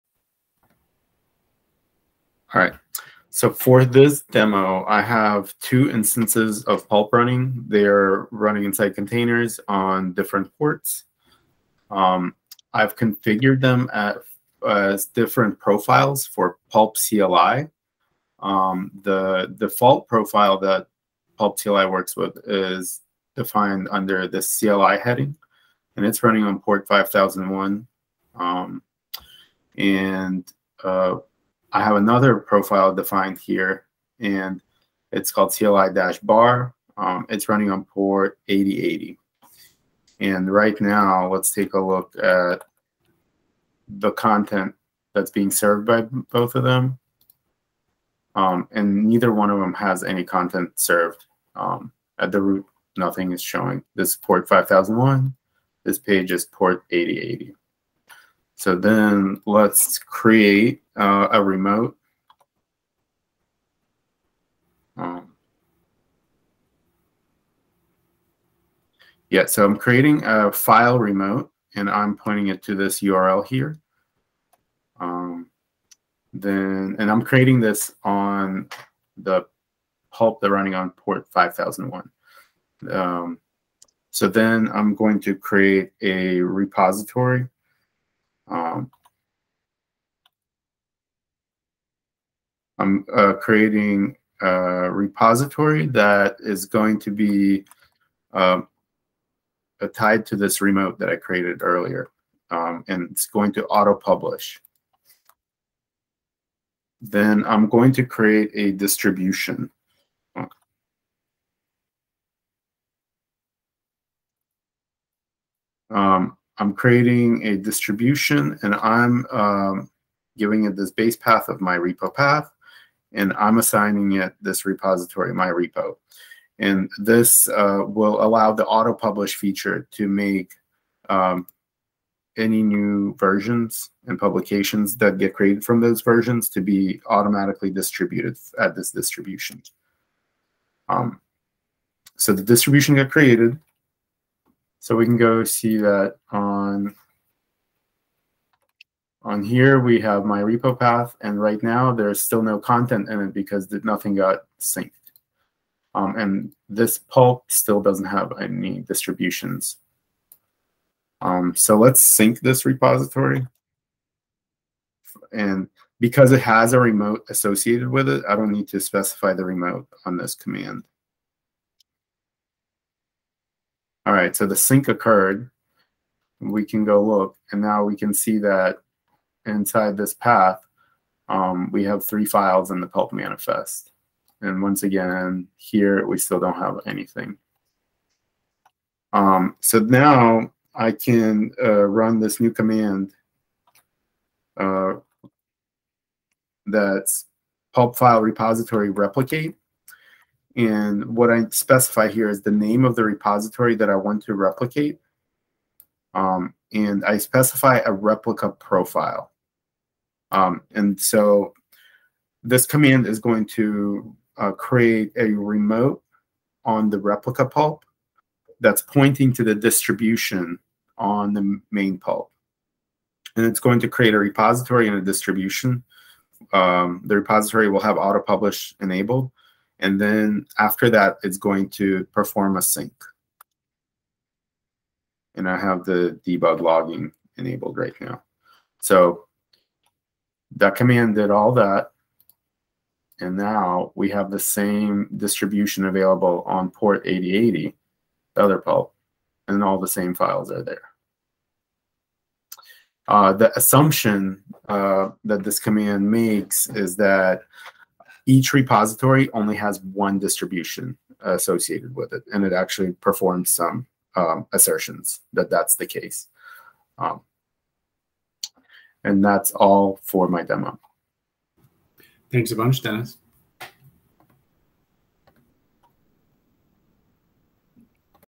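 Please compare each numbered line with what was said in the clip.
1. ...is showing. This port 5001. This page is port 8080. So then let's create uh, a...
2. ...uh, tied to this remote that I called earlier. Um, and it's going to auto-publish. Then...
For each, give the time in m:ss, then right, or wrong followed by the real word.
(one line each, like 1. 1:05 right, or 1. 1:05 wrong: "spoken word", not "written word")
1. 0:53 right
2. 1:39 wrong: "created", not "called".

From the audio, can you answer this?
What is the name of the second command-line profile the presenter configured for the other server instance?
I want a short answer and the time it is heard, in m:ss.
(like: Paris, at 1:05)
CLI-bar, at 0:35.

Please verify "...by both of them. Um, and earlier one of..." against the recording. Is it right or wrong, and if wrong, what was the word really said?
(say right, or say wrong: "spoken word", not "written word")
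wrong: "neither", not "earlier".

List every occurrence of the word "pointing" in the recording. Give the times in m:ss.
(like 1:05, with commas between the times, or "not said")
1:12, 3:38.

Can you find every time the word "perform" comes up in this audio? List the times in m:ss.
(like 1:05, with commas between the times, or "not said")
3:52, 4:22.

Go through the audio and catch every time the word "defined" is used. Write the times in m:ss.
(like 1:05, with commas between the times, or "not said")
0:23, 0:32.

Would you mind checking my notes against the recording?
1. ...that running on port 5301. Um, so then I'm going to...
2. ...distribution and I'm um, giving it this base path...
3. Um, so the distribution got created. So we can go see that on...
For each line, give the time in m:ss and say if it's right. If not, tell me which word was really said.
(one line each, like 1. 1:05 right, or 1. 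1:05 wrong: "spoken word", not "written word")
1. 1:20 wrong: "5001", not "5301"
2. 1:57 right
3. 2:20 right.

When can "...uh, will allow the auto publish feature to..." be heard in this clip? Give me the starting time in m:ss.
2:07.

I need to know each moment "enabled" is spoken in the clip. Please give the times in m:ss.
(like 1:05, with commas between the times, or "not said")
3:48, 3:57.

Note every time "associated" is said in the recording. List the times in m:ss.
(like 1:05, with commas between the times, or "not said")
2:47, 4:21.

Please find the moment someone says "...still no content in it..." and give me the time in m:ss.
2:32.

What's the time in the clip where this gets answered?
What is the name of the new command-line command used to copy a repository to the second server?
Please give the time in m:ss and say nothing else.
3:17.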